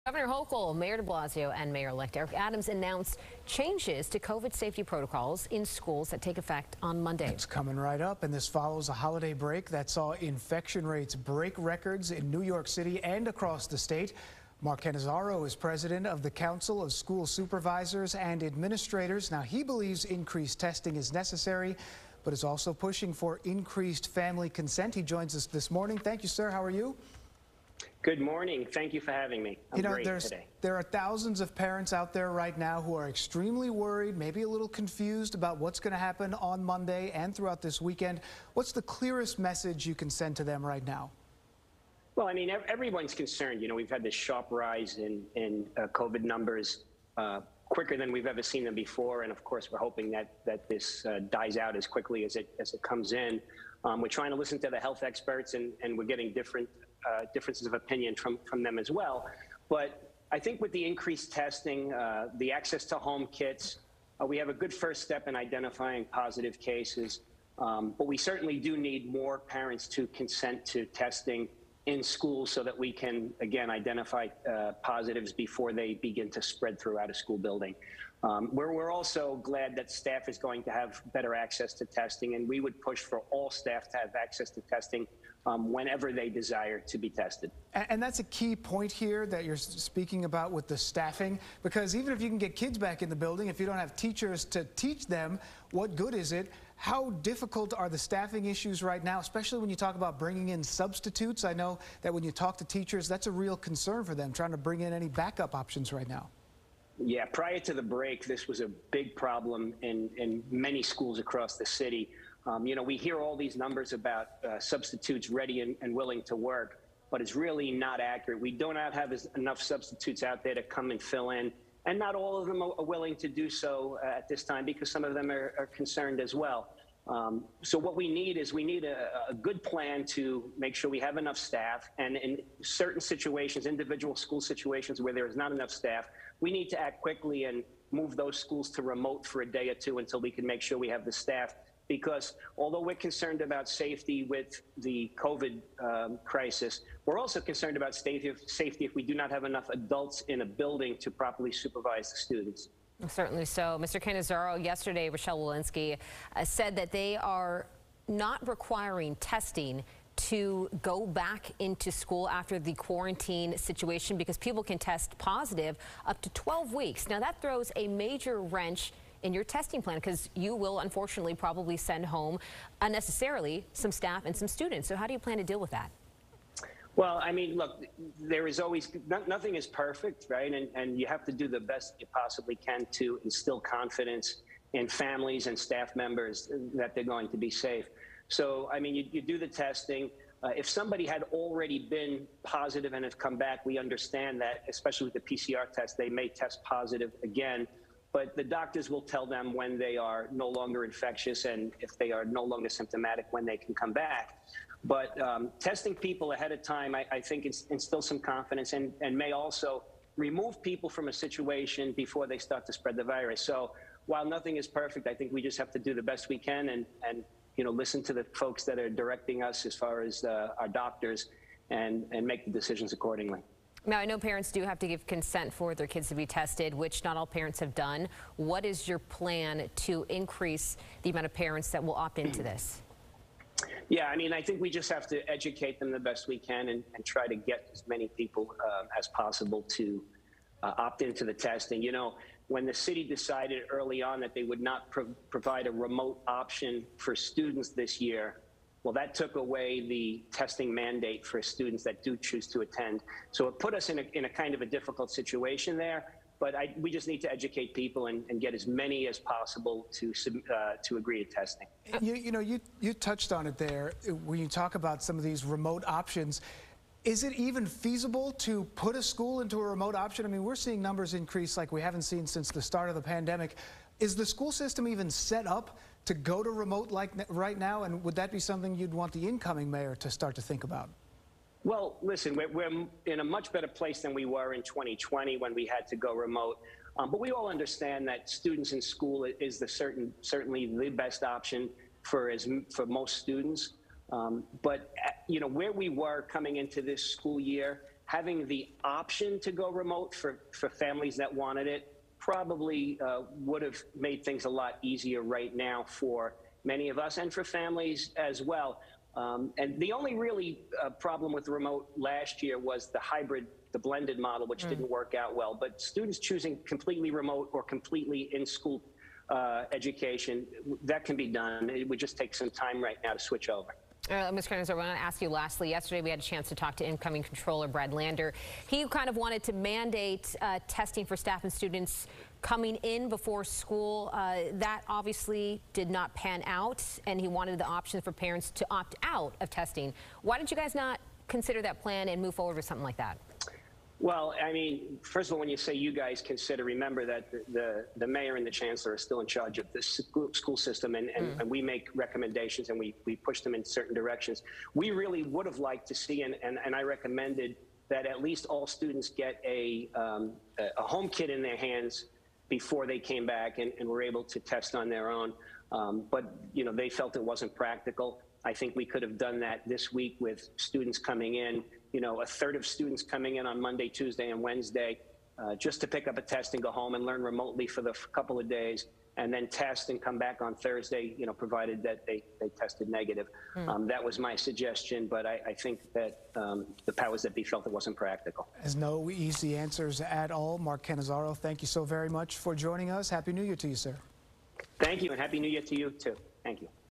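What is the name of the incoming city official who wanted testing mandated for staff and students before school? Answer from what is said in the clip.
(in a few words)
Brad Lander.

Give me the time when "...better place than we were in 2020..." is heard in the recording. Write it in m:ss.
4:43.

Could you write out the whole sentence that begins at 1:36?
How difficult are the staffing issues right now, especially when you talk about bringing in substitutes?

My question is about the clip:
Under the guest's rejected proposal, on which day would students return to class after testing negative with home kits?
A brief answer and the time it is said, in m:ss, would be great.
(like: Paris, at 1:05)
Thursday, at 6:20.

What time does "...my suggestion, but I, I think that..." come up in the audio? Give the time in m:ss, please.
6:24.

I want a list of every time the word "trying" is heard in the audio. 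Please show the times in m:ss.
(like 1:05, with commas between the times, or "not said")
0:54, 1:44.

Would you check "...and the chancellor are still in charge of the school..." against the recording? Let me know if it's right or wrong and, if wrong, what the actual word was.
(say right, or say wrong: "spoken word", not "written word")
right.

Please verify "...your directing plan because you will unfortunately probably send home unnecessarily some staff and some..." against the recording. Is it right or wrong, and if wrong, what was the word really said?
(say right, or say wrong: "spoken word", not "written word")
wrong: "testing", not "directing".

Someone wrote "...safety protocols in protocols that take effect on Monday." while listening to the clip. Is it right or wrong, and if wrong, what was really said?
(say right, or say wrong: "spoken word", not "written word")
wrong: "schools", not "protocols".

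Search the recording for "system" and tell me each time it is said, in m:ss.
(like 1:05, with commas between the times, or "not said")
4:34, 5:50.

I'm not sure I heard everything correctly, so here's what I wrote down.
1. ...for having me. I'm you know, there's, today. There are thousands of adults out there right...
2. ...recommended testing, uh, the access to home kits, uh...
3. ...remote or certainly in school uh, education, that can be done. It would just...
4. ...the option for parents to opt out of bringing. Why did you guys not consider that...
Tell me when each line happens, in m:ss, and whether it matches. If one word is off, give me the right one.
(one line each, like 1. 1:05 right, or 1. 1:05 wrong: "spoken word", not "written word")
1. 0:29 wrong: "parents", not "adults"
2. 1:00 wrong: "increased", not "recommended"
3. 5:17 wrong: "completely", not "certainly"
4. 5:37 wrong: "testing", not "bringing".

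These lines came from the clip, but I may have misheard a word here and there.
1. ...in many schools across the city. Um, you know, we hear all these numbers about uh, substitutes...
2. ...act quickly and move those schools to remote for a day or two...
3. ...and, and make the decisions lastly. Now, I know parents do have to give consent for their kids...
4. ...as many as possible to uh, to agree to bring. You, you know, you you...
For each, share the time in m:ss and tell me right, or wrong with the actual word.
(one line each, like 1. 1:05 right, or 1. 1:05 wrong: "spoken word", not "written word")
1. 1:50 right
2. 2:16 right
3. 3:41 wrong: "accordingly", not "lastly"
4. 4:18 wrong: "testing", not "bring".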